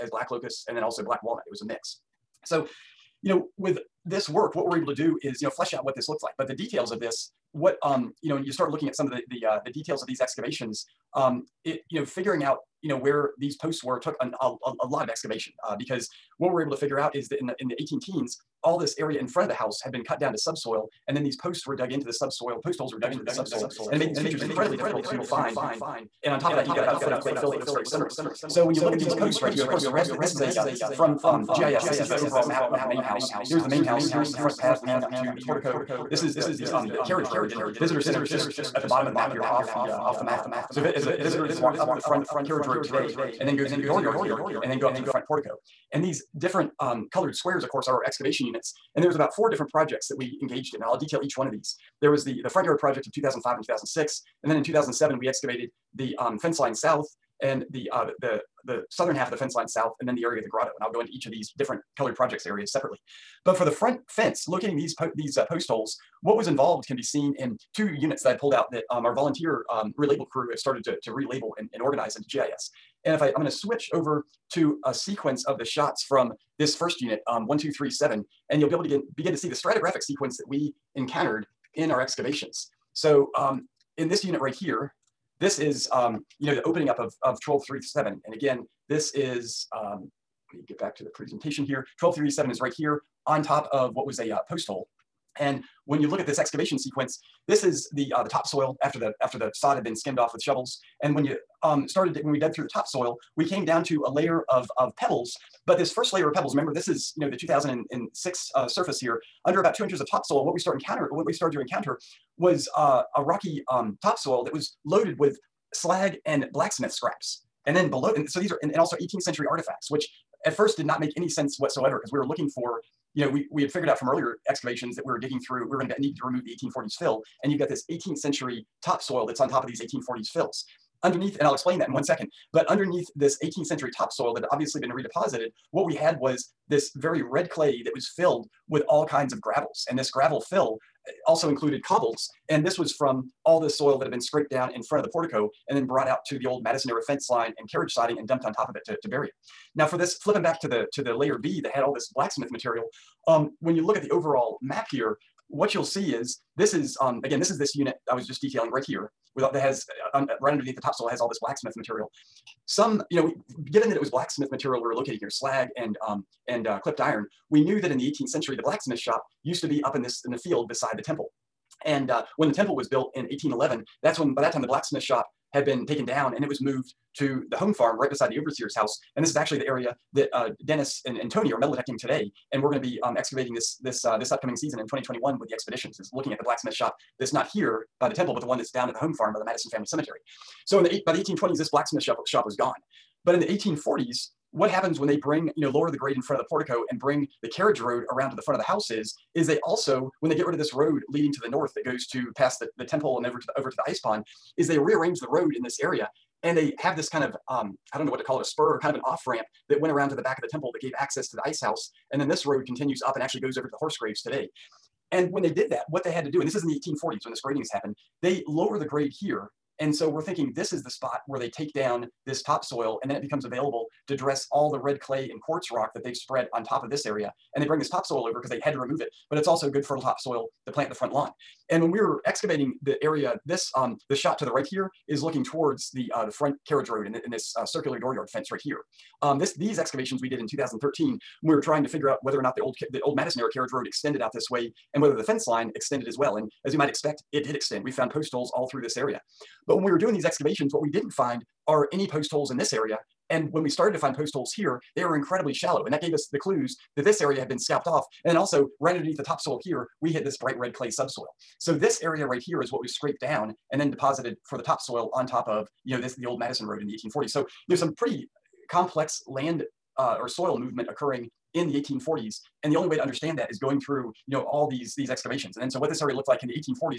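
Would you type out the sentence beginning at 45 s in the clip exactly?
And these different um, colored squares, of course, are our excavation units.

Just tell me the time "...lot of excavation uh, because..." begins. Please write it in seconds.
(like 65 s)
14 s.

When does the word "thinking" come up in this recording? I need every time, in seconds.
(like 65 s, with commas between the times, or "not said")
220 s.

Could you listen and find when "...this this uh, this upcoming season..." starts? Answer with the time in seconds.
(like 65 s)
183 s.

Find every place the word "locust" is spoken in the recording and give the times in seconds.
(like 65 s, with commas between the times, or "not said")
0 s.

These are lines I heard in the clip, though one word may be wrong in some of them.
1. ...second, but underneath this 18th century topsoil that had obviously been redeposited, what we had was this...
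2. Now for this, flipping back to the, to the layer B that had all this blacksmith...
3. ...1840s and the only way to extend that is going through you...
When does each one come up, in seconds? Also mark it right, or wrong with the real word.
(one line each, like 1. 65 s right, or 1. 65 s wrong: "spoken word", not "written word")
1. 132 s right
2. 149 s right
3. 271 s wrong: "understand", not "extend".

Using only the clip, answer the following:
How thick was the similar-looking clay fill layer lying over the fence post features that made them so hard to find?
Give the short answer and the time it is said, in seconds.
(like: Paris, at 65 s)
about a foot, at 26 s.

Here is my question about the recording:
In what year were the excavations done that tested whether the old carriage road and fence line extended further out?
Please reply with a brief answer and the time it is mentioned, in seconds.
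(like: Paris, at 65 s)
2013, at 240 s.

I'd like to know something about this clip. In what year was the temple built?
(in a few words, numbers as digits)
1811.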